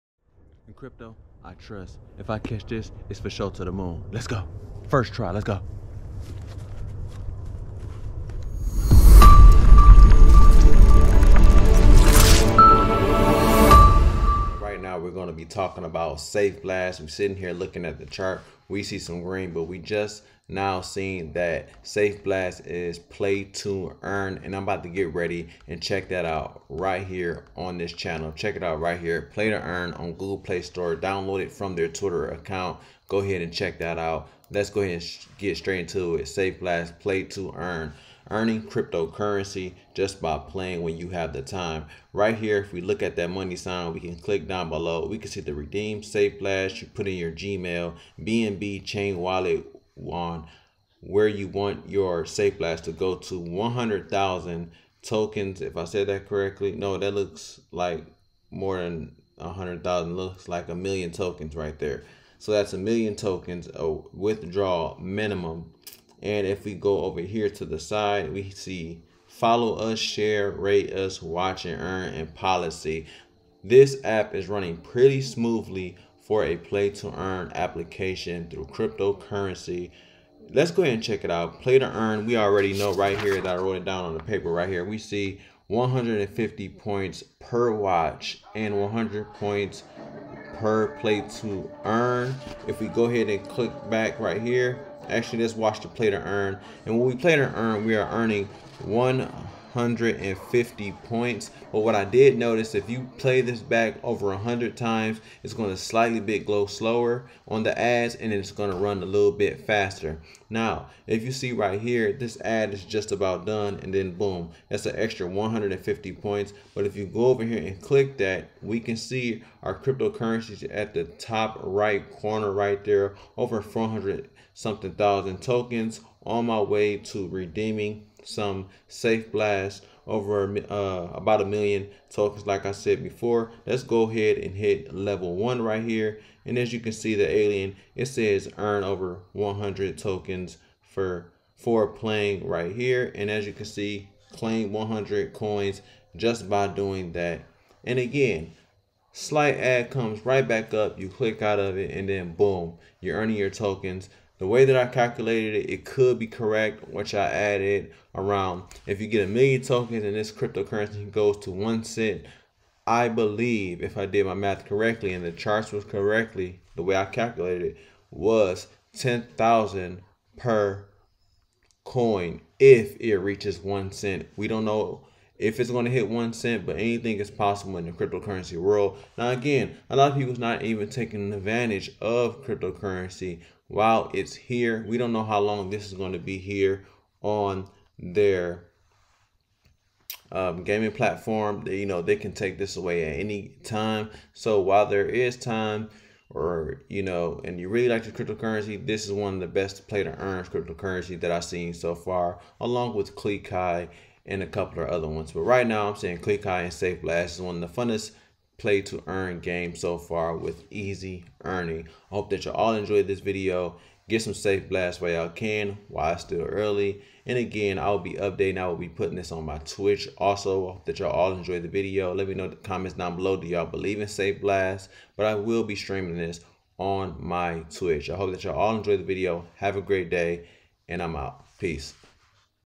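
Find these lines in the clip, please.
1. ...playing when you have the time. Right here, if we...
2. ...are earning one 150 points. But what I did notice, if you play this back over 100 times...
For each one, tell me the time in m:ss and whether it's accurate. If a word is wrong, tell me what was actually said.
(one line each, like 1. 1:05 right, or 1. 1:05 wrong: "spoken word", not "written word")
1. 0:40 right
2. 1:37 right.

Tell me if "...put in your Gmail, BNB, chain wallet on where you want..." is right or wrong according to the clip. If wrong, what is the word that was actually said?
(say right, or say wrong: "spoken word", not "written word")
right.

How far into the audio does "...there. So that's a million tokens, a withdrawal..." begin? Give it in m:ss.
1:01.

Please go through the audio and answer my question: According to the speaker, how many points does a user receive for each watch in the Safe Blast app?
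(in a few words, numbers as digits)
150.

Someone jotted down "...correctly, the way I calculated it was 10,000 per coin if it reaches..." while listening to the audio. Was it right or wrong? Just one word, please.
right.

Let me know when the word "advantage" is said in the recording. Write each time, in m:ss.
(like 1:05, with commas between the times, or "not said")
3:01.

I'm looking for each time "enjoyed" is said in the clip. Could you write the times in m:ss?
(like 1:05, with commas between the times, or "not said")
3:32, 3:41, 3:48.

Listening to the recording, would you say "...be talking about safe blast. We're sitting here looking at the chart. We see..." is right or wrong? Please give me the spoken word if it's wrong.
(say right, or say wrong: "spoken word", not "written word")
right.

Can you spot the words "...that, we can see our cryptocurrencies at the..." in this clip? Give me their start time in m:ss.
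1:58.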